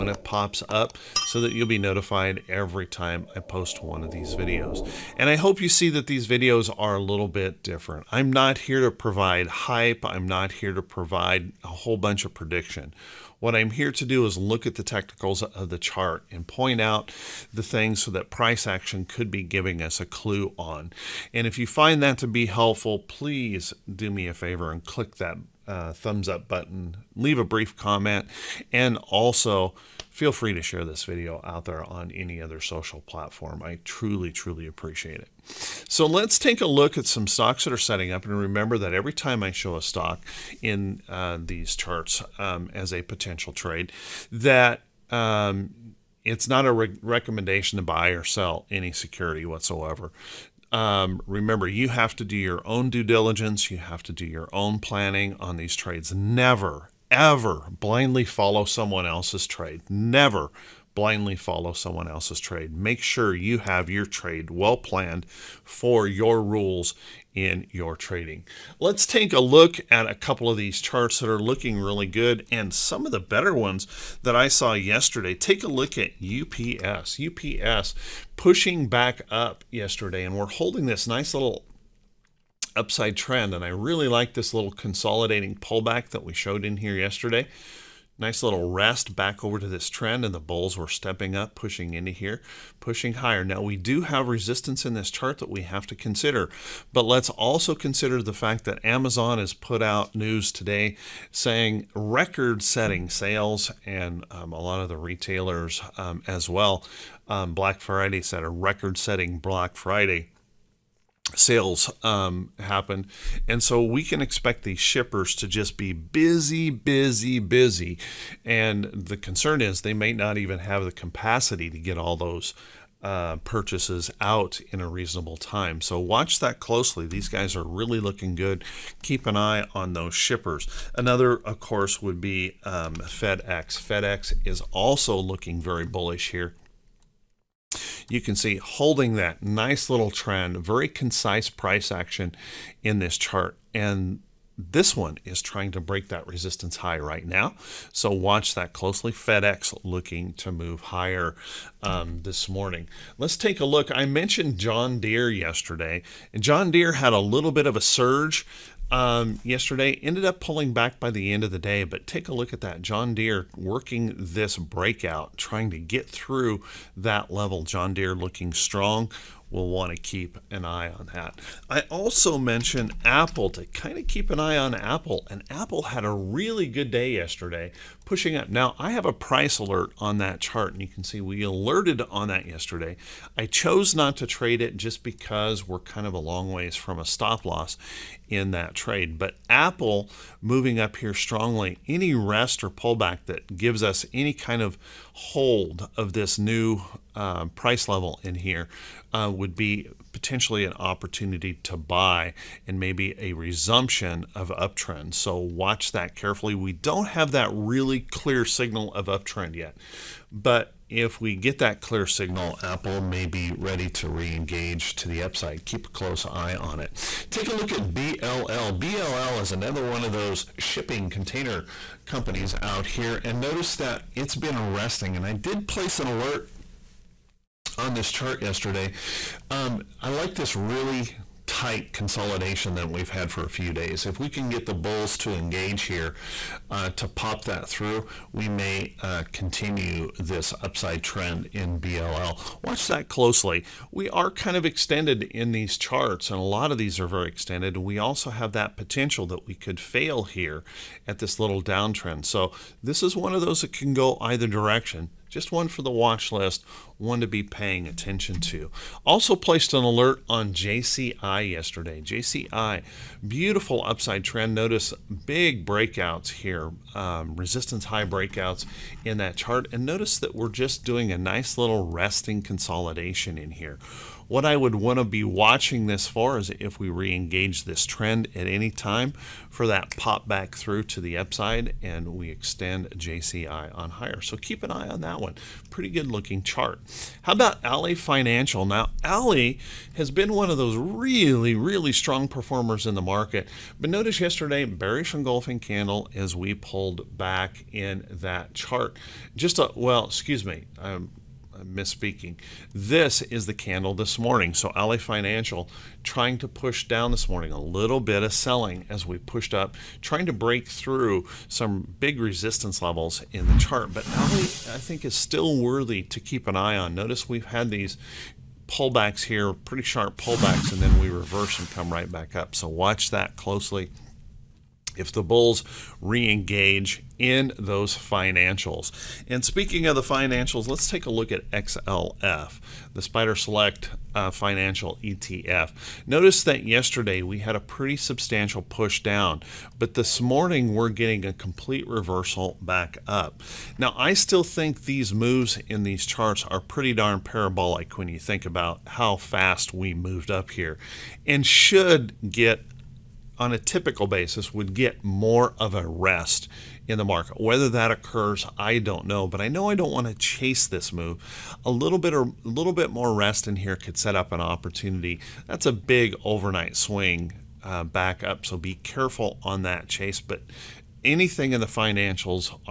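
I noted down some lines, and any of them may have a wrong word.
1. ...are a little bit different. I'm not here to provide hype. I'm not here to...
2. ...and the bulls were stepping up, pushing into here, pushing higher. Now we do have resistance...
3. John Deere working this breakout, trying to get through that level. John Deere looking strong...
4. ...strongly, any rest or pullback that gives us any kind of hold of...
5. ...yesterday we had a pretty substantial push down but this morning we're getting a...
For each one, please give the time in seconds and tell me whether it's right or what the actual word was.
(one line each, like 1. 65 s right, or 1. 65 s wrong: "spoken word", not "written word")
1. 6 s right
2. 90 s right
3. 162 s right
4. 191 s right
5. 336 s right.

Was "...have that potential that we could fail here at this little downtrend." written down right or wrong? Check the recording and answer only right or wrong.
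right.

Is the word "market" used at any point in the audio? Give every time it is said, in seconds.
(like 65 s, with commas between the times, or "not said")
293 s, 357 s.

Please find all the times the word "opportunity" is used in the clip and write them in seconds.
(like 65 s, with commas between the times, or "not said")
200 s, 364 s.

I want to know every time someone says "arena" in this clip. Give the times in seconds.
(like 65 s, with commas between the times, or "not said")
not said.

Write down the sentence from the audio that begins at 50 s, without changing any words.
Um, remember, you have to do your own due diligence.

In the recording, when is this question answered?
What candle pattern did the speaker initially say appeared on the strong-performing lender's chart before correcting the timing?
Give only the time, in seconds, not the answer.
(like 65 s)
294 s.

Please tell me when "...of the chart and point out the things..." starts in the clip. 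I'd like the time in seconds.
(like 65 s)
15 s.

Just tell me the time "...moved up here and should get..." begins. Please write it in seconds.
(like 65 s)
349 s.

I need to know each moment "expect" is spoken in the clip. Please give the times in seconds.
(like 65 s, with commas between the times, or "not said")
114 s.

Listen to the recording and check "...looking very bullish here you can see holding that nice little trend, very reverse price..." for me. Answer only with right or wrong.
wrong.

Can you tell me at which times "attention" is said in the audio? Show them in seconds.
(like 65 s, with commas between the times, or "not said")
257 s.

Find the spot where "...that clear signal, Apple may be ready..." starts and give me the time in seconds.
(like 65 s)
211 s.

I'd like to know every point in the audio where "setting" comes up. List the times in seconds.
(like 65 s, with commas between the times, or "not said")
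37 s, 102 s, 108 s.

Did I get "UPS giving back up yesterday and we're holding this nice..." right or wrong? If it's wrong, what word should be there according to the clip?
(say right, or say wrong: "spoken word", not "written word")
wrong: "pushing", not "giving".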